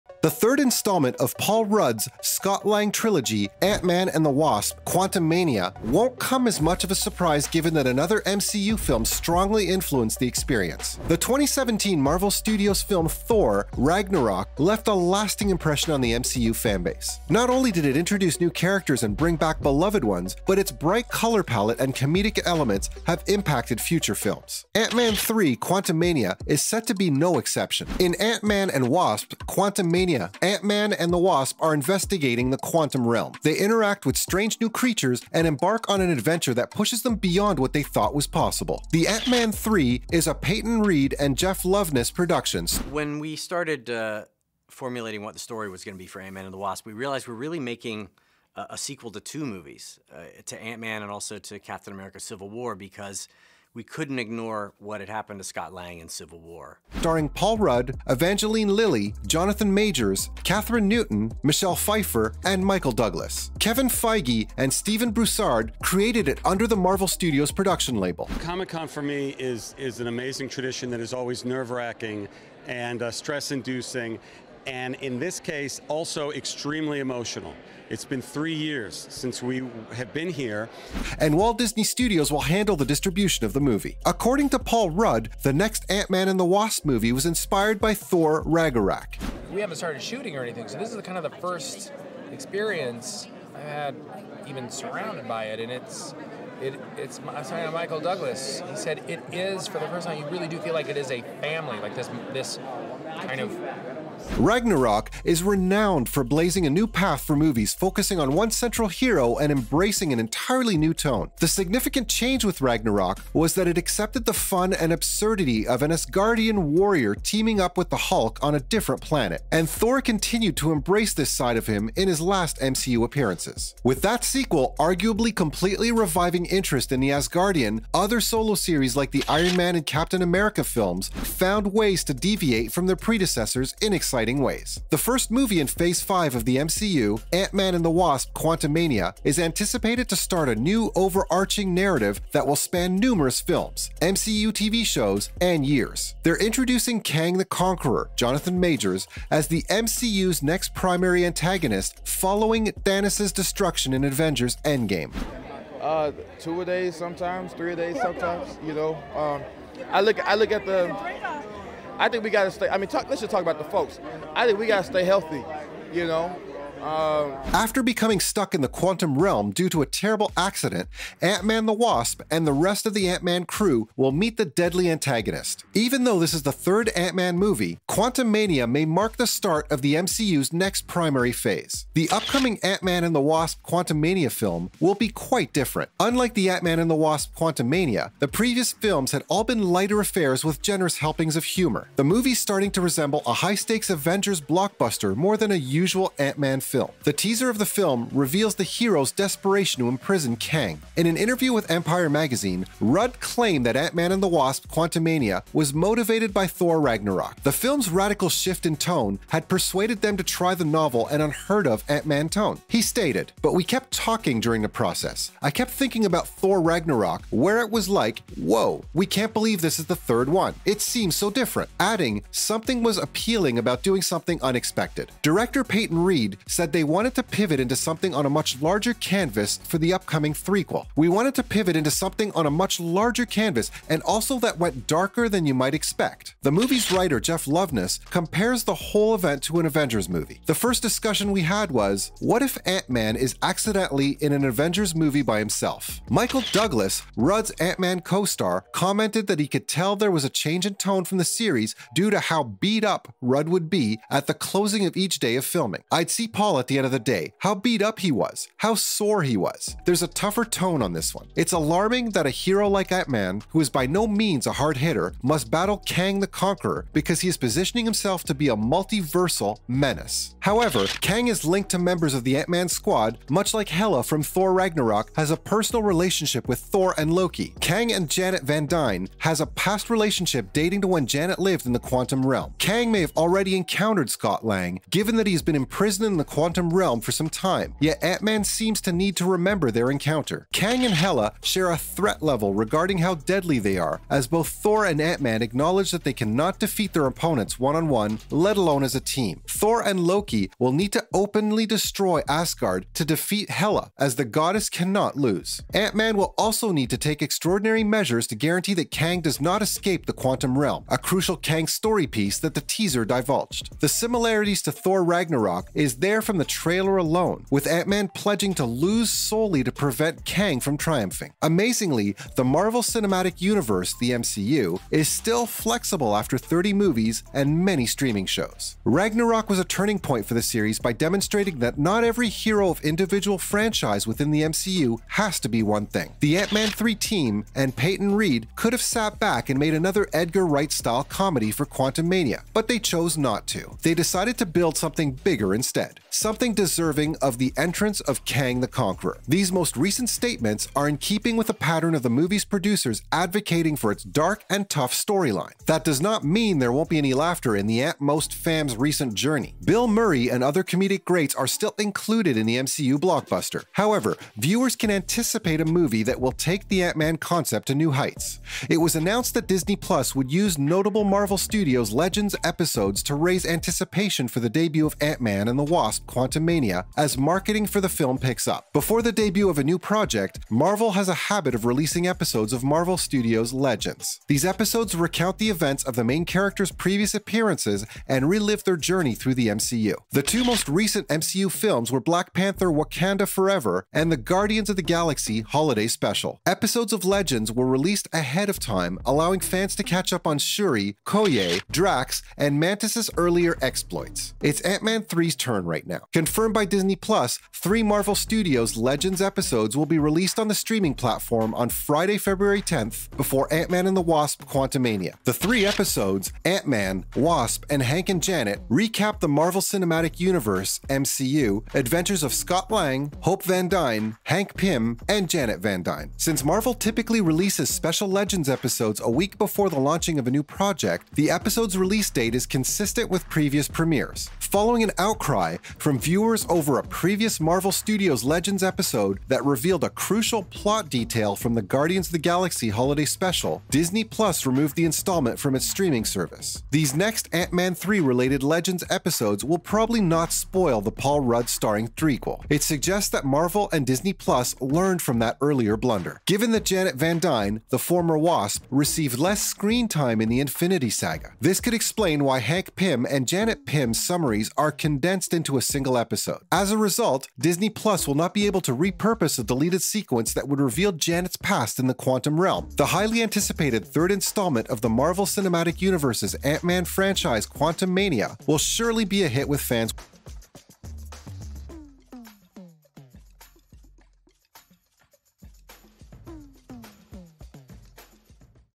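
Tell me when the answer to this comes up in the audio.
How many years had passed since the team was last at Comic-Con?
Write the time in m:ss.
1:18.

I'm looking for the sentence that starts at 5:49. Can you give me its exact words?
These most recent statements are in keeping with the pattern of the movie's producers advocating for its dark and tough storyline.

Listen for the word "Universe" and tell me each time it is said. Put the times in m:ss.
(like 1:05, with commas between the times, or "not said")
5:23, 7:00, 7:55.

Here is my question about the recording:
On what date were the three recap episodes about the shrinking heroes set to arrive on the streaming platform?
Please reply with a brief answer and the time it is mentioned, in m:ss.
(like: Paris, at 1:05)
February 10, at 6:52.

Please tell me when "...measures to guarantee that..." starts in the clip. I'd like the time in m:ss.
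5:07.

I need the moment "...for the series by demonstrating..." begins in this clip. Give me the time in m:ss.
5:30.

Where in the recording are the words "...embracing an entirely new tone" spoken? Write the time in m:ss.
1:49.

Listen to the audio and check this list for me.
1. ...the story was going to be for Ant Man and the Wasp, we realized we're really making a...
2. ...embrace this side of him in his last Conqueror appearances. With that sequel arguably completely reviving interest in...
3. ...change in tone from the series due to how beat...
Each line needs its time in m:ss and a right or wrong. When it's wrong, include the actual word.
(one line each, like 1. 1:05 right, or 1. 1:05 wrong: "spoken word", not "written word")
1. 0:45 right
2. 2:00 wrong: "MCU", not "Conqueror"
3. 4:10 right.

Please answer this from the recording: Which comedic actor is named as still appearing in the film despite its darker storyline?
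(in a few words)
Bill Murray.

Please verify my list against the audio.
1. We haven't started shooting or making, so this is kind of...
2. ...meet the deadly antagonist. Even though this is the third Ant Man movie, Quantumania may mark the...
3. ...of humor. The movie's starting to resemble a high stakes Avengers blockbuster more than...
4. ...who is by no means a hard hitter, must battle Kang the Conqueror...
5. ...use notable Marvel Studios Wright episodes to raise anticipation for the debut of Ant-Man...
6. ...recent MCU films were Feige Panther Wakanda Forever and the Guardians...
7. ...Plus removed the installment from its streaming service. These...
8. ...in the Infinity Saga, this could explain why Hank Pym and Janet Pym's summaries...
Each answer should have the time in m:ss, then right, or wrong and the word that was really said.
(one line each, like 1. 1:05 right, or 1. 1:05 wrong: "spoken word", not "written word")
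1. 1:29 wrong: "anything", not "making"
2. 2:54 right
3. 3:11 right
4. 4:23 right
5. 6:10 wrong: "Legends", not "Wright"
6. 6:30 wrong: "Black", not "Feige"
7. 7:24 right
8. 7:40 right.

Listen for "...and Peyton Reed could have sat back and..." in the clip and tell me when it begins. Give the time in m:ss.
5:37.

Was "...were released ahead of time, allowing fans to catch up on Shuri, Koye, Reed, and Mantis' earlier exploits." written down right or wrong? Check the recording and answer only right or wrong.
wrong.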